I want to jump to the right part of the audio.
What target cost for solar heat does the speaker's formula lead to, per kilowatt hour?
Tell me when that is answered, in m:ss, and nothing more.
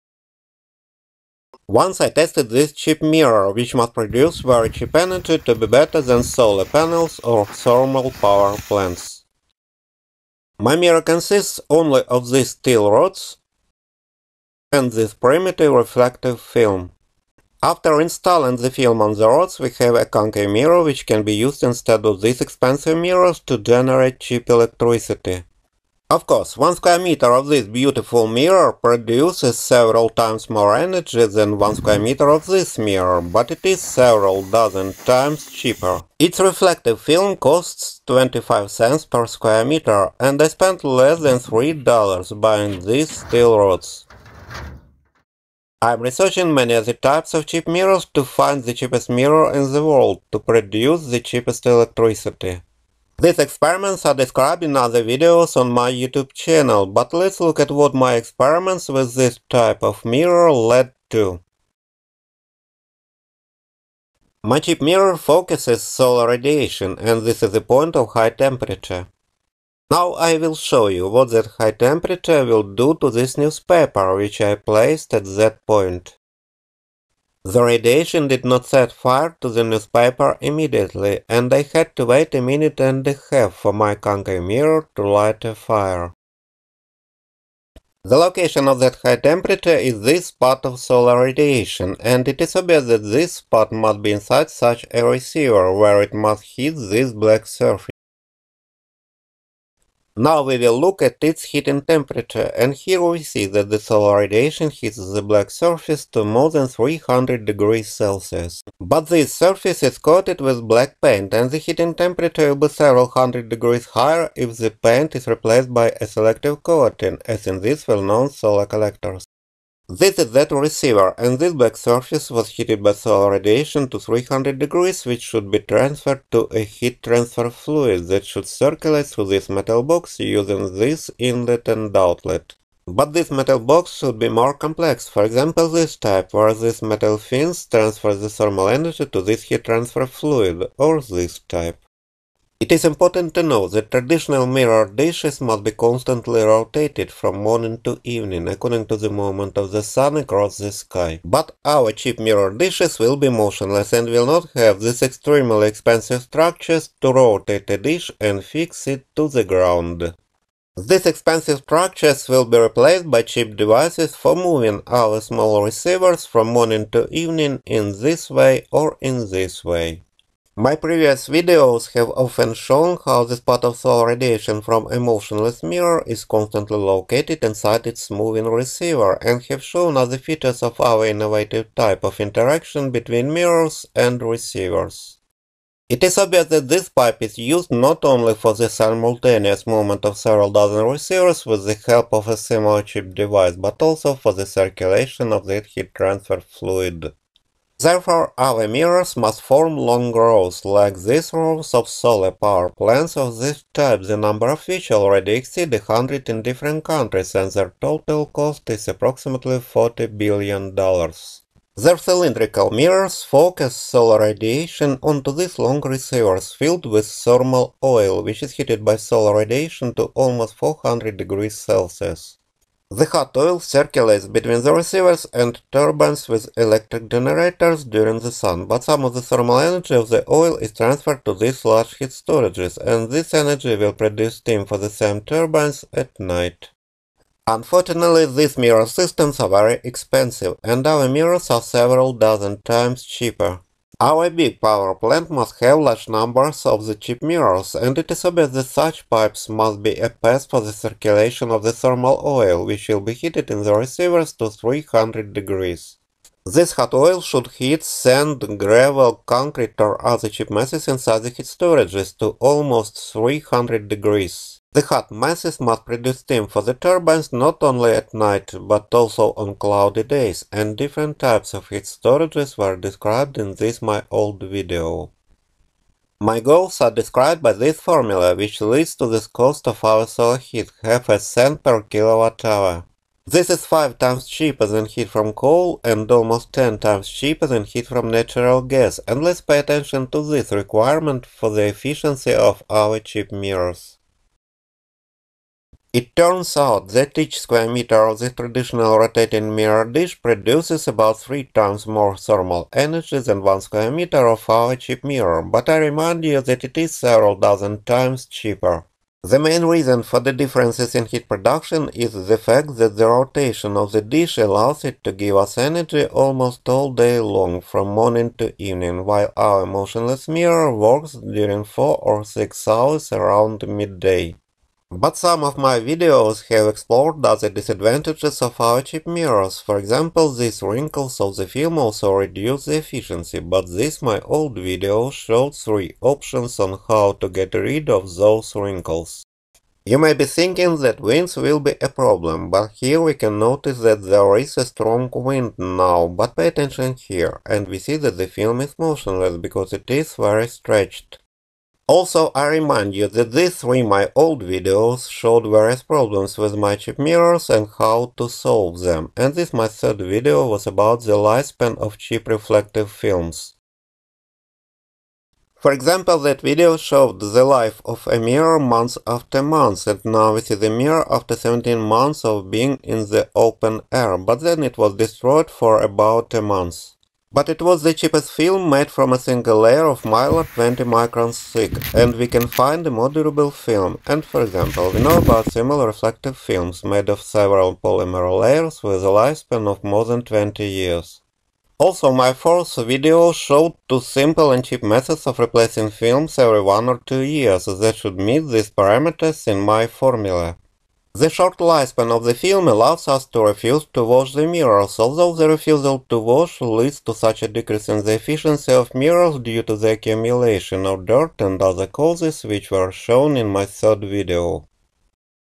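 4:40.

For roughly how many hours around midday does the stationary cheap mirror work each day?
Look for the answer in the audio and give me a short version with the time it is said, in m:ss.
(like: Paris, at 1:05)
4 or 6 hours, at 5:21.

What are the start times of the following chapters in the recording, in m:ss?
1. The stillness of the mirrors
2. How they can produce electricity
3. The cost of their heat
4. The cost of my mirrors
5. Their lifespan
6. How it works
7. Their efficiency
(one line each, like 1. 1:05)
1. 2:22
2. 3:17
3. 4:35
4. 0:26
5. 6:04
6. 1:02
7. 4:55.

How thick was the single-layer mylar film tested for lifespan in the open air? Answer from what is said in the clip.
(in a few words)
20 microns.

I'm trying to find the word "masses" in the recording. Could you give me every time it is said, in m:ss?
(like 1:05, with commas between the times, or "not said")
4:20, 4:25.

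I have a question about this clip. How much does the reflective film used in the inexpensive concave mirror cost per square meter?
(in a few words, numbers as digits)
25 cents.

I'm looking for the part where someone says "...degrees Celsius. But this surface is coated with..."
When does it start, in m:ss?
1:47.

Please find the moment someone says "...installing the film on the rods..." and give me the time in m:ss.
0:17.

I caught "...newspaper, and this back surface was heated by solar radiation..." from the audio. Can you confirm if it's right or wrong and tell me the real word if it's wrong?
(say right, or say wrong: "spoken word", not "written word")
wrong: "receiver", not "newspaper".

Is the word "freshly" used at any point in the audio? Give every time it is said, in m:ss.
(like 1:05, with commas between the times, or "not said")
not said.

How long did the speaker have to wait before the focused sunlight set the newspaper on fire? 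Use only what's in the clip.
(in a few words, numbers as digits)
a minute and a half.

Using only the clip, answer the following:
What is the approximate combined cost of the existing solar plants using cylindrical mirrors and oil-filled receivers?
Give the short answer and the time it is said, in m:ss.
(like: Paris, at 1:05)
$40 billion, at 3:29.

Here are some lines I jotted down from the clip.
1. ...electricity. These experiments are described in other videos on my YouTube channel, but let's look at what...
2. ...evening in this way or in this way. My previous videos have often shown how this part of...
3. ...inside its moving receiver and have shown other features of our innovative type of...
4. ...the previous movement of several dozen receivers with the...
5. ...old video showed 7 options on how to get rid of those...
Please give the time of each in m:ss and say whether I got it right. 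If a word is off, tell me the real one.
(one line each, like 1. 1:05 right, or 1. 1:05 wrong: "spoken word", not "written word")
1. 0:51 right
2. 2:47 right
3. 2:57 right
4. 3:08 wrong: "simultaneous", not "previous"
5. 5:34 wrong: "3", not "7".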